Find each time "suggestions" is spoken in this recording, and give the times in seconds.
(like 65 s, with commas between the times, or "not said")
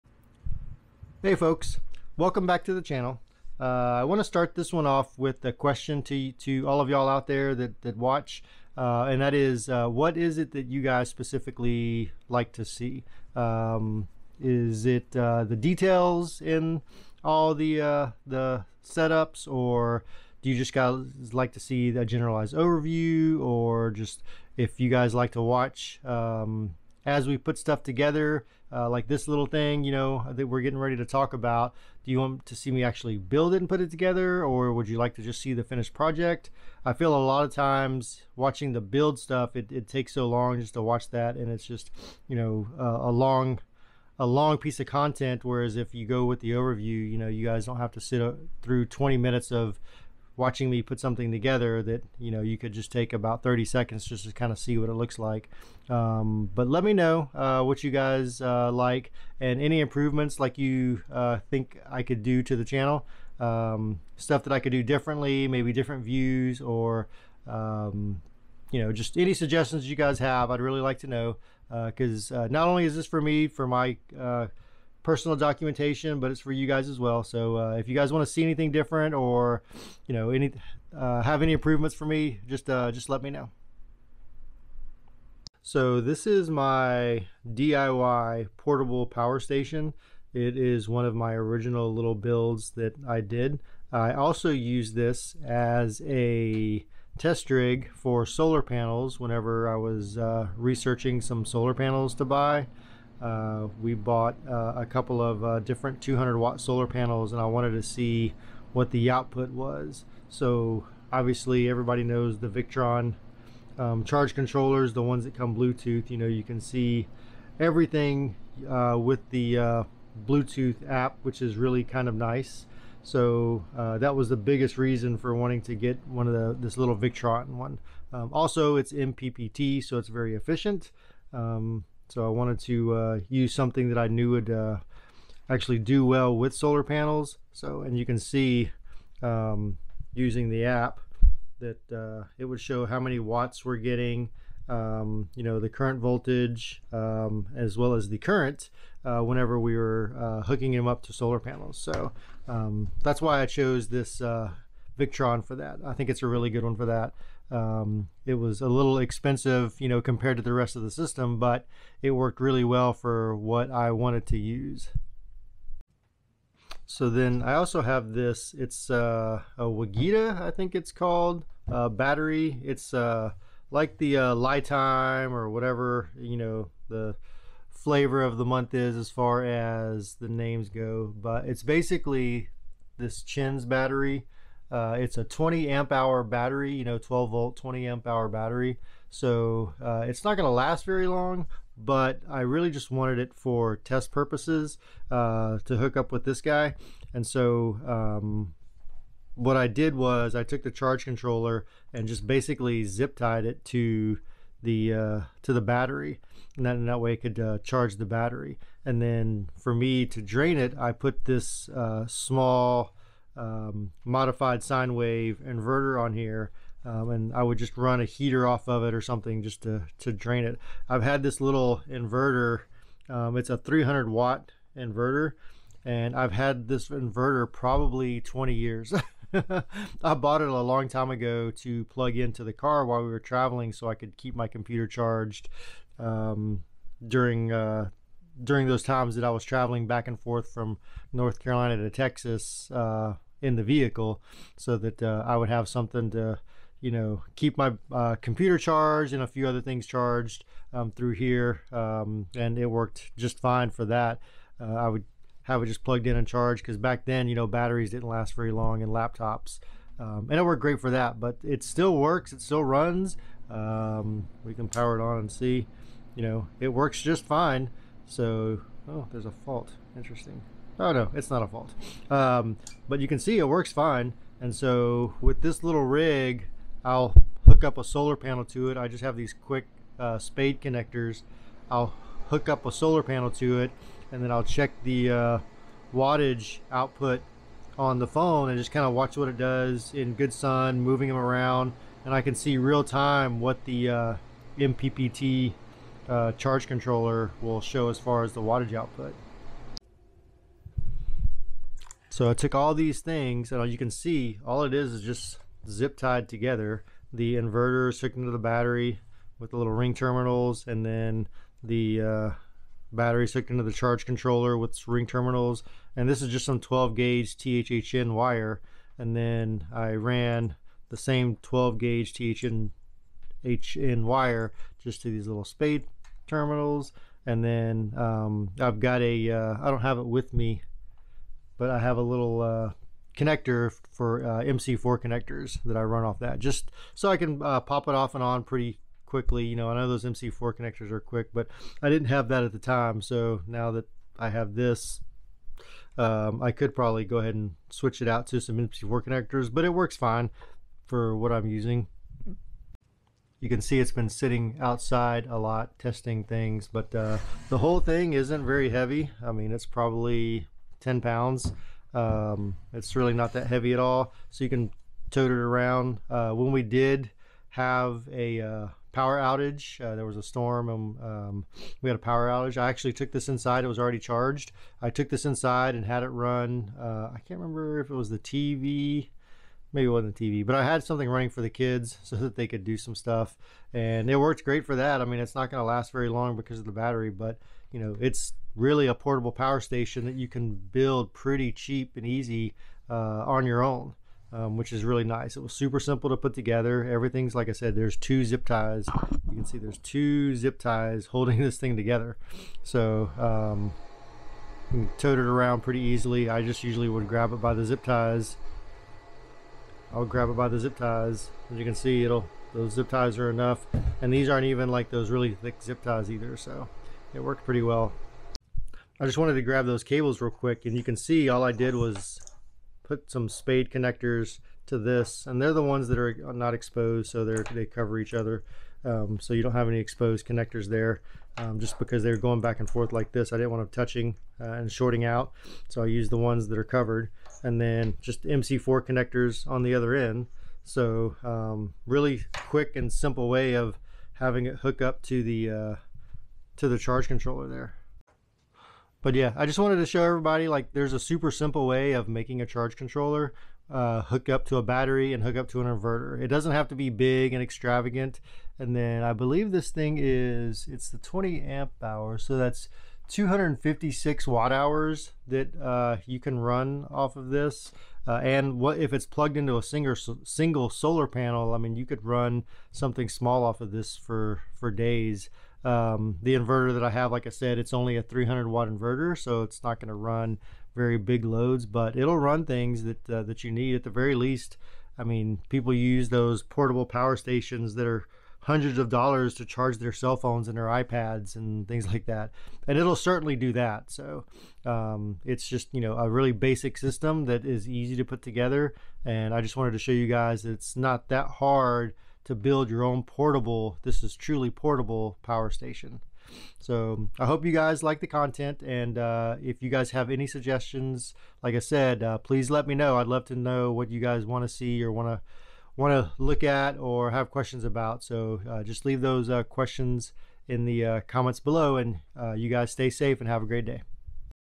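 69 s, 510 s.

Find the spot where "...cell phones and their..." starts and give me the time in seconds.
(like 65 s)
489 s.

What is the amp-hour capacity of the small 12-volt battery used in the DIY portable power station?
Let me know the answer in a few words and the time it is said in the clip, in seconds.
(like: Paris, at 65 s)
20 amp hour, at 186 s.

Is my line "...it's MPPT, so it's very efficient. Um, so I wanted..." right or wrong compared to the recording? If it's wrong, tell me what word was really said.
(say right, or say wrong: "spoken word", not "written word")
right.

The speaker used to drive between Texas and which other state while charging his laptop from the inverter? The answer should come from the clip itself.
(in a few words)
North Carolina.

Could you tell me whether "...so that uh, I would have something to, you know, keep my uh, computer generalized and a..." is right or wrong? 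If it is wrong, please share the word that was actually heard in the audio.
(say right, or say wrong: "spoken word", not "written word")
wrong: "charged", not "generalized".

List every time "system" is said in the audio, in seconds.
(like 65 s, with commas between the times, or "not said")
160 s, 496 s.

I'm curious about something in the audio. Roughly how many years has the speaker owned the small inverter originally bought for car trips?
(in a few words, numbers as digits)
20 years.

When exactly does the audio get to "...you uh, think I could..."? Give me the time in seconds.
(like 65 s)
60 s.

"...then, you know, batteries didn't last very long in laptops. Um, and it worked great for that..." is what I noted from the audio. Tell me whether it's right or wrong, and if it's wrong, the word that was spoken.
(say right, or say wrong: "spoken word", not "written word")
right.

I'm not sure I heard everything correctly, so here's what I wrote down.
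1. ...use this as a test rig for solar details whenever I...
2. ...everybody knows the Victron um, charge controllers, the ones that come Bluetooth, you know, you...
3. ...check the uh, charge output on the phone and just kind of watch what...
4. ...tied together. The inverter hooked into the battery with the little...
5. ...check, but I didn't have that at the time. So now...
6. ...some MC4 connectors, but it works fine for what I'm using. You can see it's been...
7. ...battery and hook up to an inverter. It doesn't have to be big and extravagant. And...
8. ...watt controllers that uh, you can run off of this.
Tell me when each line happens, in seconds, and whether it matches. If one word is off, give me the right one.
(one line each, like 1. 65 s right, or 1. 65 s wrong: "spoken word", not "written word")
1. 94 s wrong: "panels", not "details"
2. 111 s right
3. 284 s wrong: "wattage", not "charge"
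4. 305 s right
5. 340 s wrong: "quick", not "check"
6. 348 s right
7. 454 s right
8. 464 s wrong: "hours", not "controllers".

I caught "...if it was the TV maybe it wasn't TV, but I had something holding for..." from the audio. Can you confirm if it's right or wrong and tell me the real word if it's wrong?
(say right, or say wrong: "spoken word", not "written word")
wrong: "running", not "holding".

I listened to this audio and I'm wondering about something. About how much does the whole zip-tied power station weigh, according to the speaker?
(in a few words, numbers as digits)
10 pounds.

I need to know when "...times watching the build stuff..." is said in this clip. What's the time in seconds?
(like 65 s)
37 s.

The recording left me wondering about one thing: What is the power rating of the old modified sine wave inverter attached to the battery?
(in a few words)
300 watt.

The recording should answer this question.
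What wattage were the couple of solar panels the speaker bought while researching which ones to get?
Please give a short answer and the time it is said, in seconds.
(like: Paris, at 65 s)
200 watt, at 106 s.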